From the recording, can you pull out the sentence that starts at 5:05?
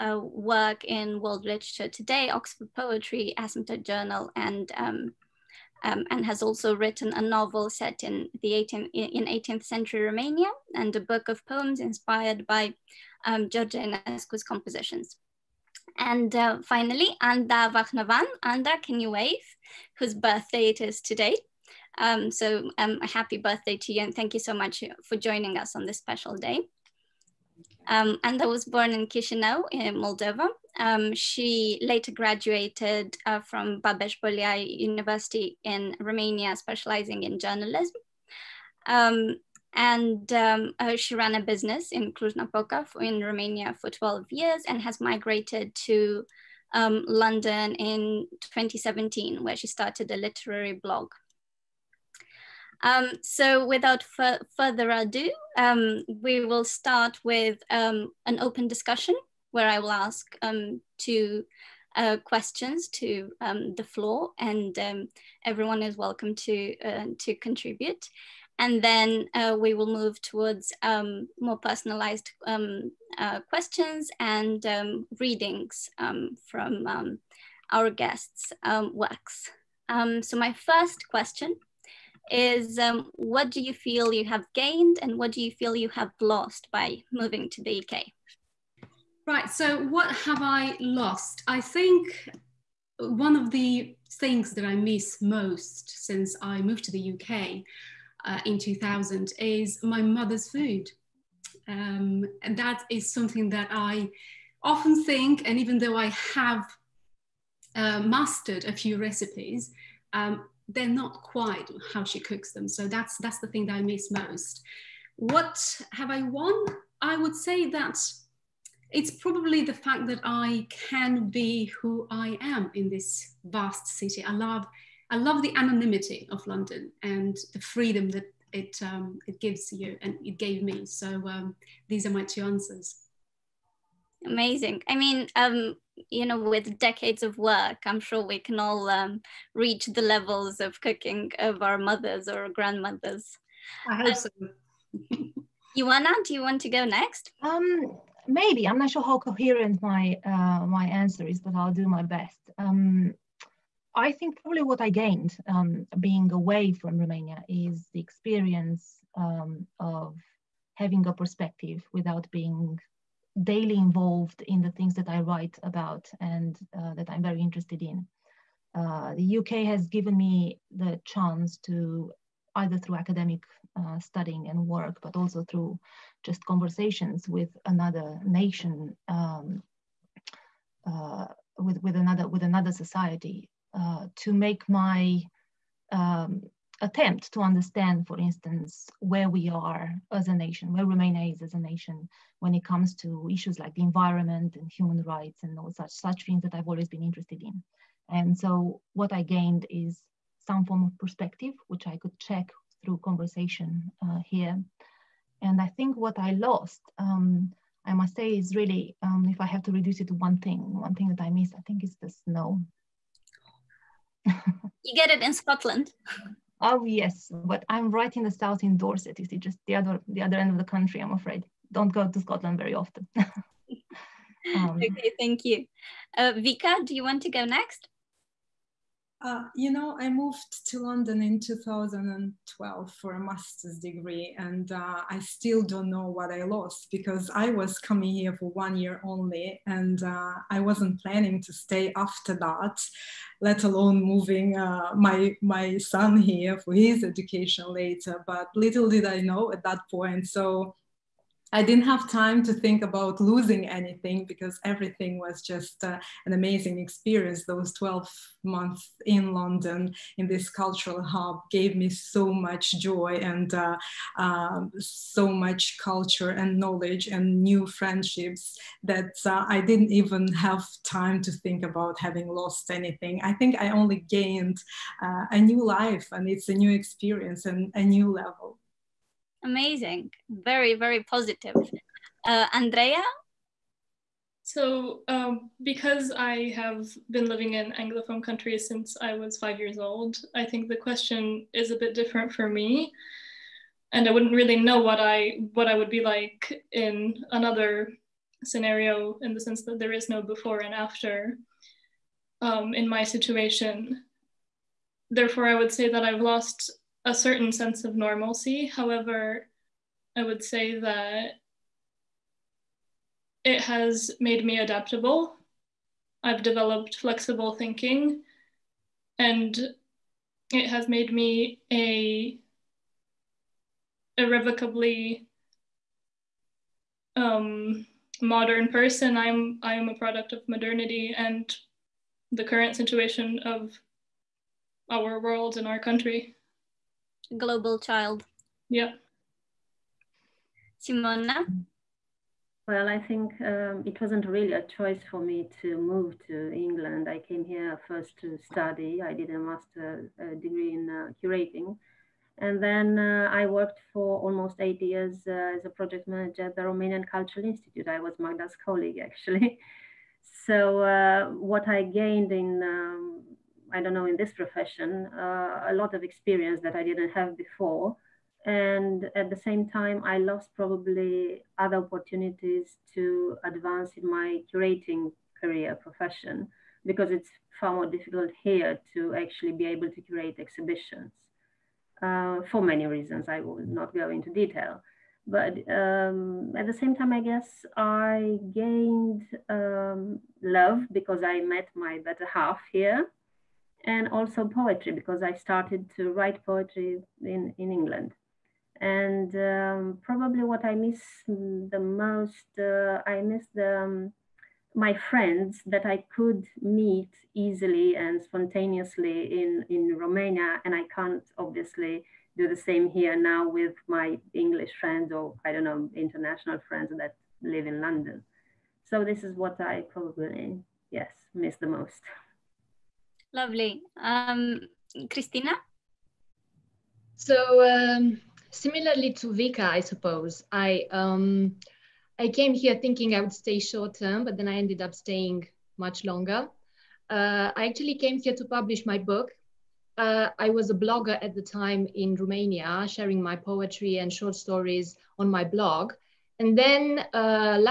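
Therefore, I would say that I've lost a certain sense of normalcy.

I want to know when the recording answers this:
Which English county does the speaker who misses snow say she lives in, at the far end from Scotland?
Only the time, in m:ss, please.
3:38.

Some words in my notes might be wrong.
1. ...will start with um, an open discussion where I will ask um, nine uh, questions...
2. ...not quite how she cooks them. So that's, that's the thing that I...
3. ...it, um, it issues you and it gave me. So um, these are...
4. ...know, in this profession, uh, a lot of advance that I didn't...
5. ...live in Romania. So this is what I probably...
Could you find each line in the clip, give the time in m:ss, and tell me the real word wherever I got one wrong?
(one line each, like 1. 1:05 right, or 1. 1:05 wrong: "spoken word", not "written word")
1. 0:56 wrong: "two", not "nine"
2. 1:50 right
3. 2:08 wrong: "gives", not "issues"
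4. 6:03 wrong: "experience", not "advance"
5. 6:57 wrong: "London", not "Romania".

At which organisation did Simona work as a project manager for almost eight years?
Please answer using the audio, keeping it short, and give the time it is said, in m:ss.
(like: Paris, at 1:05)
Romanian Cultural Institute, at 5:56.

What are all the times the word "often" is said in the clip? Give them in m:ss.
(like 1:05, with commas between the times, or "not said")
1:44, 3:42.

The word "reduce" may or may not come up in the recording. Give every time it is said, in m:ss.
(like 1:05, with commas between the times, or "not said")
3:29.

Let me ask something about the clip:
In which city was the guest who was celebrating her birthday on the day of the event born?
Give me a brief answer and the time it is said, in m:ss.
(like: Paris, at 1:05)
Chisinau, at 0:29.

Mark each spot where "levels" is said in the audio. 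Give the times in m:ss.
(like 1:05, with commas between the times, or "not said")
2:20, 4:38.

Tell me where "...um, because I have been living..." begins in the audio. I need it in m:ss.
4:45.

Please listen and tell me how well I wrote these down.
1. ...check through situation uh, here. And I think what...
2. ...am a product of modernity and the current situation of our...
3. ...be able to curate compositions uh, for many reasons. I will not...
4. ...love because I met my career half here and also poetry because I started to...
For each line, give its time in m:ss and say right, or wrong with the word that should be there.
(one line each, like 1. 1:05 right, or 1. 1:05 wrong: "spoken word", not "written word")
1. 3:22 wrong: "conversation", not "situation"
2. 5:29 right
3. 6:19 wrong: "exhibitions", not "compositions"
4. 6:30 wrong: "better", not "career".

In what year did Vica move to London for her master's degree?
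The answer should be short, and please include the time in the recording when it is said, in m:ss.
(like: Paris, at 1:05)
2012, at 3:51.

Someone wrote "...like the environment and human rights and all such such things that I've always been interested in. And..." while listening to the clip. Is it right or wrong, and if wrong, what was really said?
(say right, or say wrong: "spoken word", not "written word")
right.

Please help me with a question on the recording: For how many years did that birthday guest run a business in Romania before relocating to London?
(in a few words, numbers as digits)
12.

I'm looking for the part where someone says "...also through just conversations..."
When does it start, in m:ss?
2:55.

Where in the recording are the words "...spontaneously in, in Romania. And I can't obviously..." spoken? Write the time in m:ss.
6:48.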